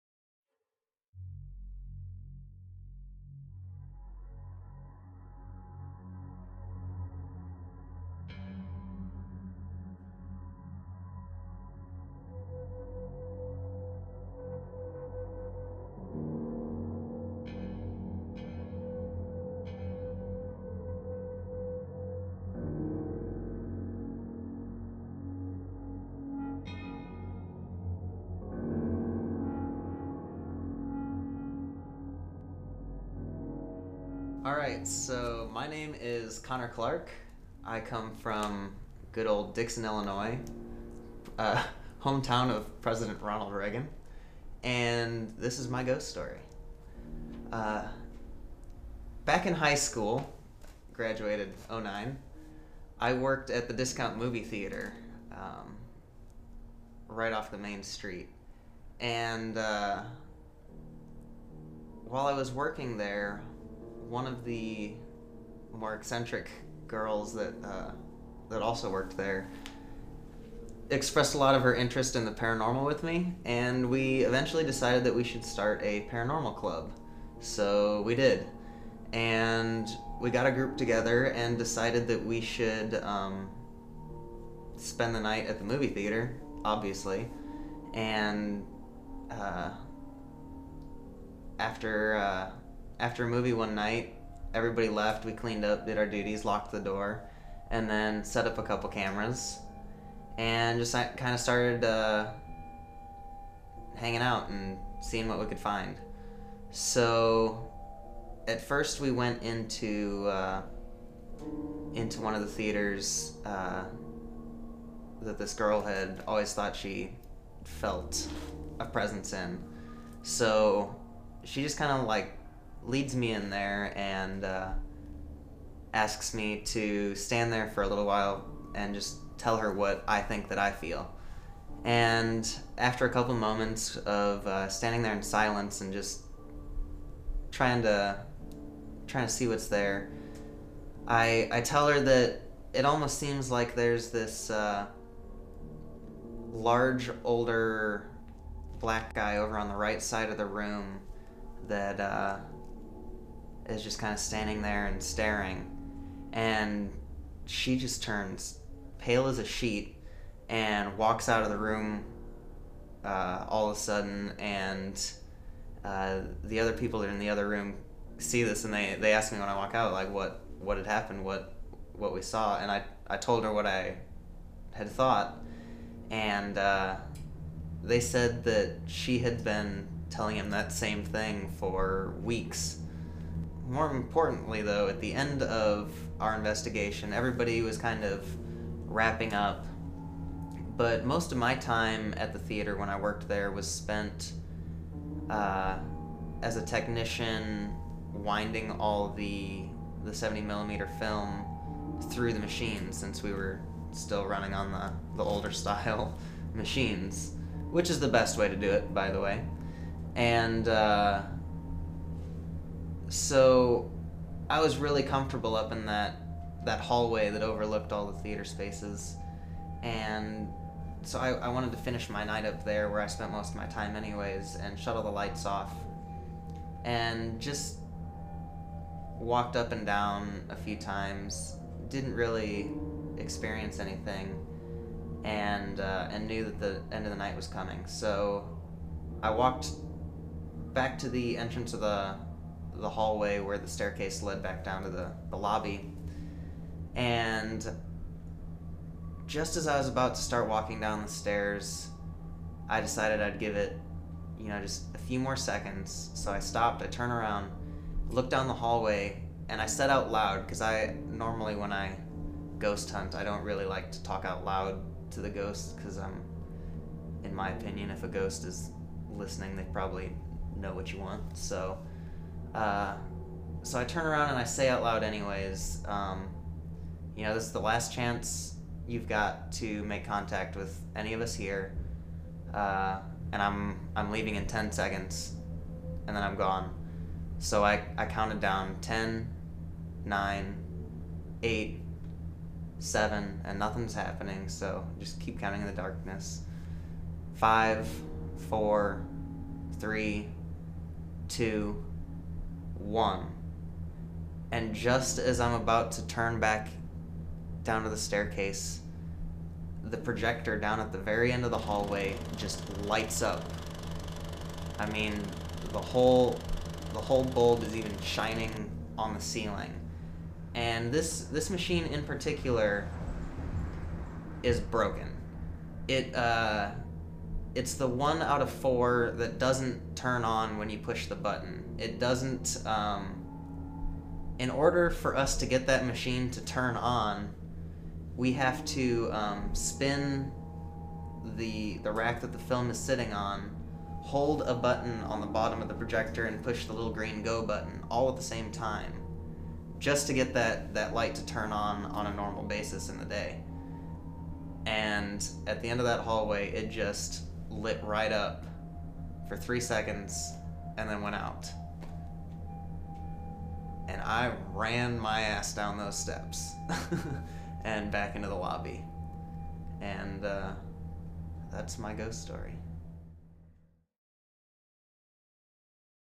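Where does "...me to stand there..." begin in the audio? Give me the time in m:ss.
2:06.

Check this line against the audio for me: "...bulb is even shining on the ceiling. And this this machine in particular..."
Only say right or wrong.
right.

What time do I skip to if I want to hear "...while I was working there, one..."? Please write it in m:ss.
1:02.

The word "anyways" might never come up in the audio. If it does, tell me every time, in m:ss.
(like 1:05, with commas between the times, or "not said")
3:43, 4:35.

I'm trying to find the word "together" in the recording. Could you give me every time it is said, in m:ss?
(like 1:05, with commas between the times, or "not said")
1:20.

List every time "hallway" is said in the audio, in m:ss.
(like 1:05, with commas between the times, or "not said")
3:36, 4:02, 4:18, 5:11, 5:56.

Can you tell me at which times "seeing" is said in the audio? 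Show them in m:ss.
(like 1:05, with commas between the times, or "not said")
1:45.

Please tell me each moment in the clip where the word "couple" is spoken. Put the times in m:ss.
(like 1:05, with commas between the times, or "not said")
1:38, 2:13.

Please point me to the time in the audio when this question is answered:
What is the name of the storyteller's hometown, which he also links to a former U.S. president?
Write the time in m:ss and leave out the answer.
0:39.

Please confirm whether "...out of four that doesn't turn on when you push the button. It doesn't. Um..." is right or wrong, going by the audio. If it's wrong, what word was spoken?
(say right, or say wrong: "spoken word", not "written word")
right.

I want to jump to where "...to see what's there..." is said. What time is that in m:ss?
2:19.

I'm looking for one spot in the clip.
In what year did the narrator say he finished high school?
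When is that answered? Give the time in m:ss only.
0:51.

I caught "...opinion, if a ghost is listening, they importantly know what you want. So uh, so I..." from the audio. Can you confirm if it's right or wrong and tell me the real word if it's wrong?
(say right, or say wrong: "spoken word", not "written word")
wrong: "probably", not "importantly".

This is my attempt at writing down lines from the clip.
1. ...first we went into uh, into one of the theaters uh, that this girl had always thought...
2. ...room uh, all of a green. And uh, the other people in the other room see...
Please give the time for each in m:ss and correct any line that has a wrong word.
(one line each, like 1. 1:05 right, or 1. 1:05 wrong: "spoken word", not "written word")
1. 1:48 right
2. 2:41 wrong: "sudden", not "green".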